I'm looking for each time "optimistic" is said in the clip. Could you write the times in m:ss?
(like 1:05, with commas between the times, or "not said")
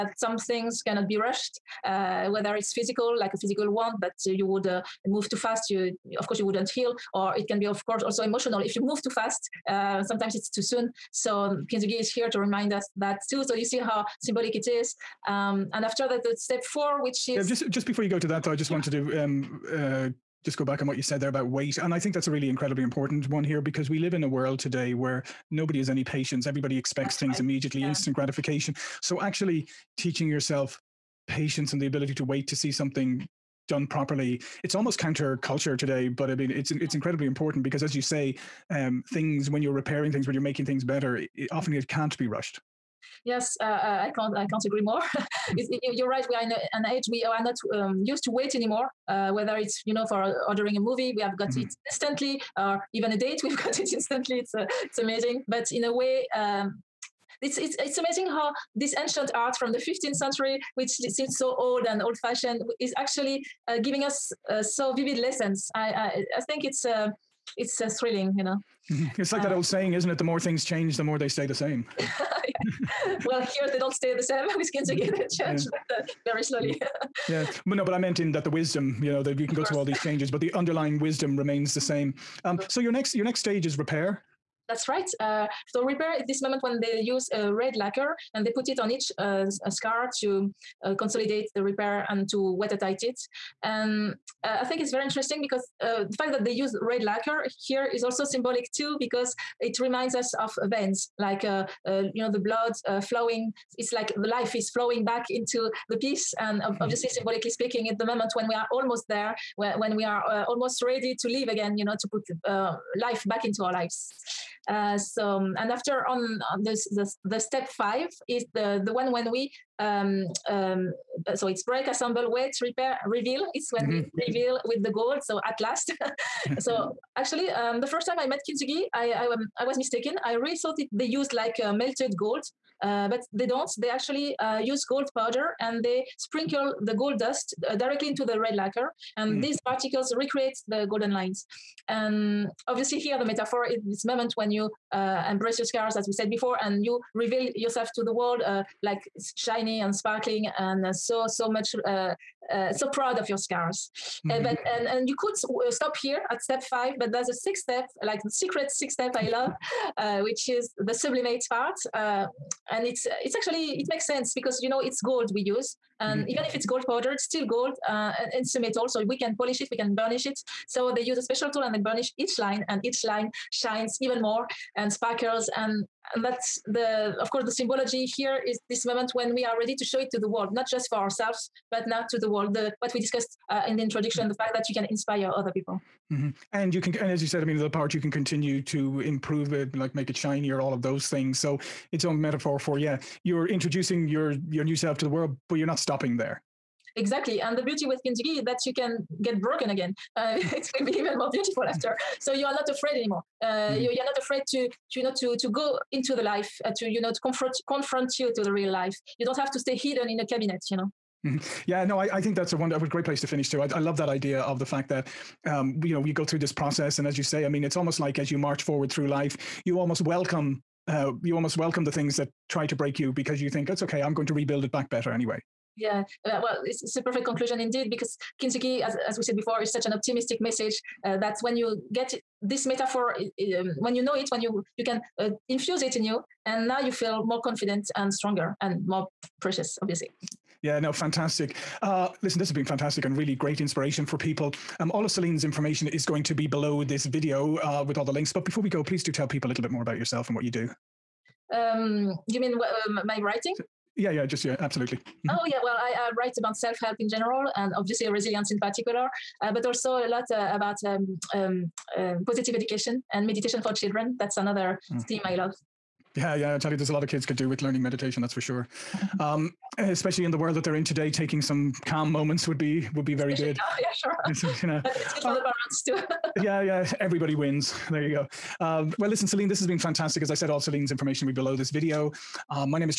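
3:49.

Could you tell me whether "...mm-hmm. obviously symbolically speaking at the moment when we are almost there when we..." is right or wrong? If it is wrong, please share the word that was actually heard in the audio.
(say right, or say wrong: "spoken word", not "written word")
right.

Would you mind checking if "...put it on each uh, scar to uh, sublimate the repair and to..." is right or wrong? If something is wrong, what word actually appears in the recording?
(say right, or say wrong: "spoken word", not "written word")
wrong: "consolidate", not "sublimate".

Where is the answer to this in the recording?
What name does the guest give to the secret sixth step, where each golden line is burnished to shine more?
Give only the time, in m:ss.
2:40.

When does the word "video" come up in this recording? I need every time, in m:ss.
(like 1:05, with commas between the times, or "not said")
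4:07, 4:41.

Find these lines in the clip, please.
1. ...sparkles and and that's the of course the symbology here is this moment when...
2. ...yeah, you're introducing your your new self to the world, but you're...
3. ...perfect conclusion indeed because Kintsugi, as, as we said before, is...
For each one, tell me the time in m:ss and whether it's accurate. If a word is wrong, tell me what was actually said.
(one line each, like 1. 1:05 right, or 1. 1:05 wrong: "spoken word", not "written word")
1. 2:54 right
2. 3:12 right
3. 3:47 right.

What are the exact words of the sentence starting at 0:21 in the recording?
And I think that's a really incredibly important one here because we live in a world today where nobody has any patience.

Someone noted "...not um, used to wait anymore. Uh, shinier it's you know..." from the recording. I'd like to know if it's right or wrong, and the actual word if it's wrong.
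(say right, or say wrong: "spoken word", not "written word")
wrong: "whether", not "shinier".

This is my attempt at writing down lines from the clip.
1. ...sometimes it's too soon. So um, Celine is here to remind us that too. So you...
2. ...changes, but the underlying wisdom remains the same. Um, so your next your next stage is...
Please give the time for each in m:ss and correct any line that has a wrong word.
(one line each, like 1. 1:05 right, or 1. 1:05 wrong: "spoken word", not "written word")
1. 0:10 wrong: "Kintsugi", not "Celine"
2. 1:20 right.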